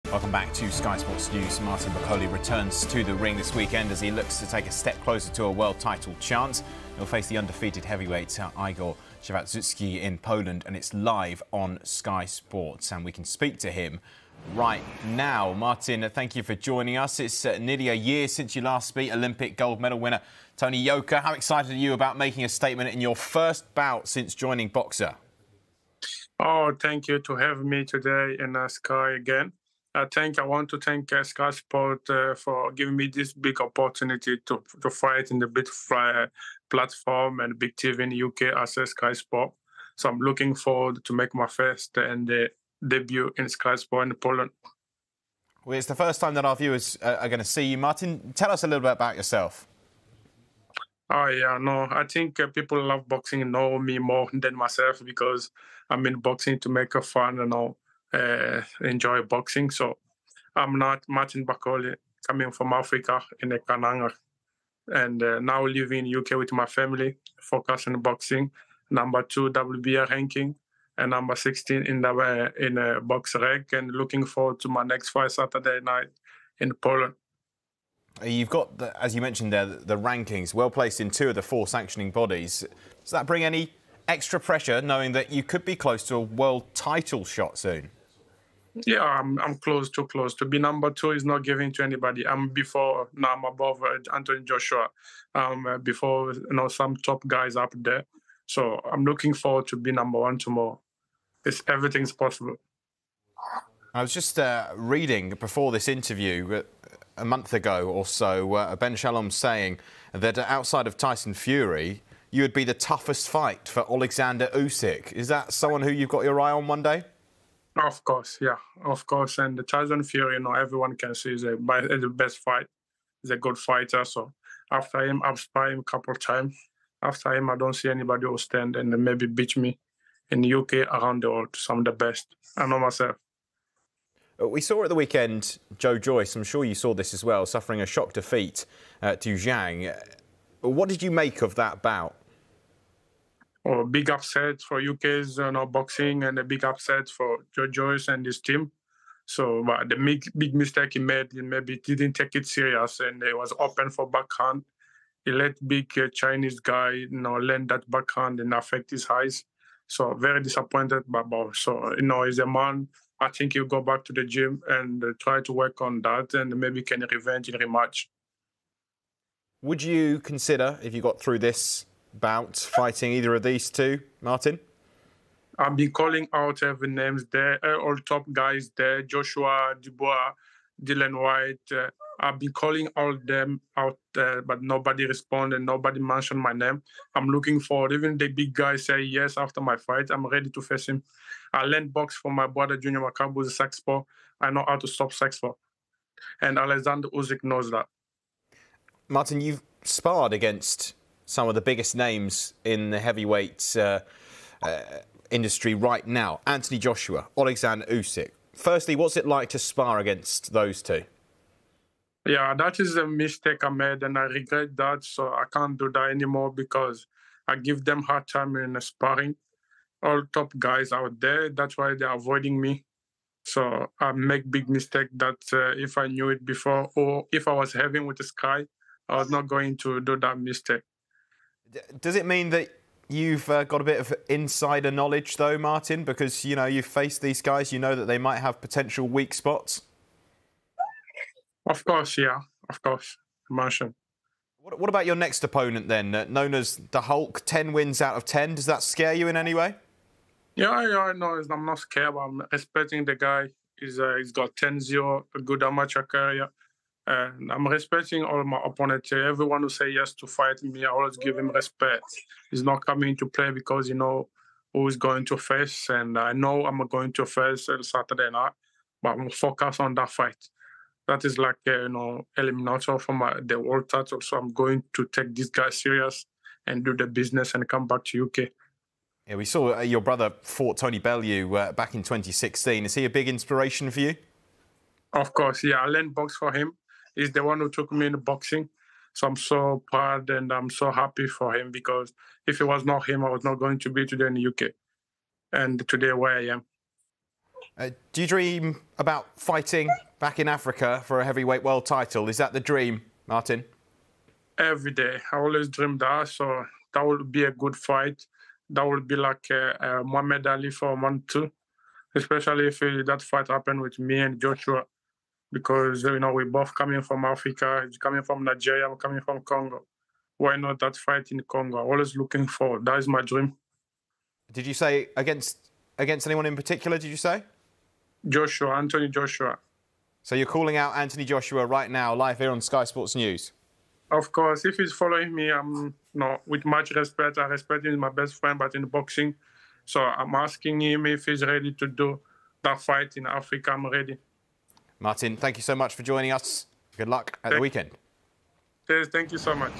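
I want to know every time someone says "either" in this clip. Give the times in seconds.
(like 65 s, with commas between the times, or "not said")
173 s.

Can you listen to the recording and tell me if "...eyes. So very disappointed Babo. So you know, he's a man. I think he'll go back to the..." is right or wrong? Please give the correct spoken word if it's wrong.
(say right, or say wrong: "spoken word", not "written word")
right.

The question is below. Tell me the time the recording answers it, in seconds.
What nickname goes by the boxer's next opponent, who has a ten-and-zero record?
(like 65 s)
246 s.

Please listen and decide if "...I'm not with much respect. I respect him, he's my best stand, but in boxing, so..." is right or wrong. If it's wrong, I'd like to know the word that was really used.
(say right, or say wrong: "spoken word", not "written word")
wrong: "friend", not "stand".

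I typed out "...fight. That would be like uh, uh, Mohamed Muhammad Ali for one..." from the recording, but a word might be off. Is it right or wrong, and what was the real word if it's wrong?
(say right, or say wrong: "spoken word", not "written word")
right.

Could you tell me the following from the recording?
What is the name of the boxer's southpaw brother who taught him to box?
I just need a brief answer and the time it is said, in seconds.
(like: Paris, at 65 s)
Junior Makabu, at 192 s.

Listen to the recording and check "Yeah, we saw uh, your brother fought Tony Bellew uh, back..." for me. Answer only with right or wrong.
right.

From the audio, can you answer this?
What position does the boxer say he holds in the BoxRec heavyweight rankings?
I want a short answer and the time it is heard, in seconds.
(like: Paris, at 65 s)
16, at 71 s.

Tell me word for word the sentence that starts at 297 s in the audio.
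Uh, do you dream about fighting back in Africa for a heavyweight world title?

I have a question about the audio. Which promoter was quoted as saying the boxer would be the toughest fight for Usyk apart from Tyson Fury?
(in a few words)
Ben Shalom.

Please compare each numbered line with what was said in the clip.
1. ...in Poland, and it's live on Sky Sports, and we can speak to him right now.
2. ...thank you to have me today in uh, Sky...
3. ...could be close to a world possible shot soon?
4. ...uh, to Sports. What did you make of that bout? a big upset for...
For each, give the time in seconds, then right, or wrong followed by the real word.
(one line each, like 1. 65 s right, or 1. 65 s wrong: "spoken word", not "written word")
1. 10 s right
2. 26 s right
3. 85 s wrong: "title", not "possible"
4. 139 s wrong: "Zhang", not "Sports".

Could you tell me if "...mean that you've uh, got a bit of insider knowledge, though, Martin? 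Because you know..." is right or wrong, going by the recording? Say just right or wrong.
right.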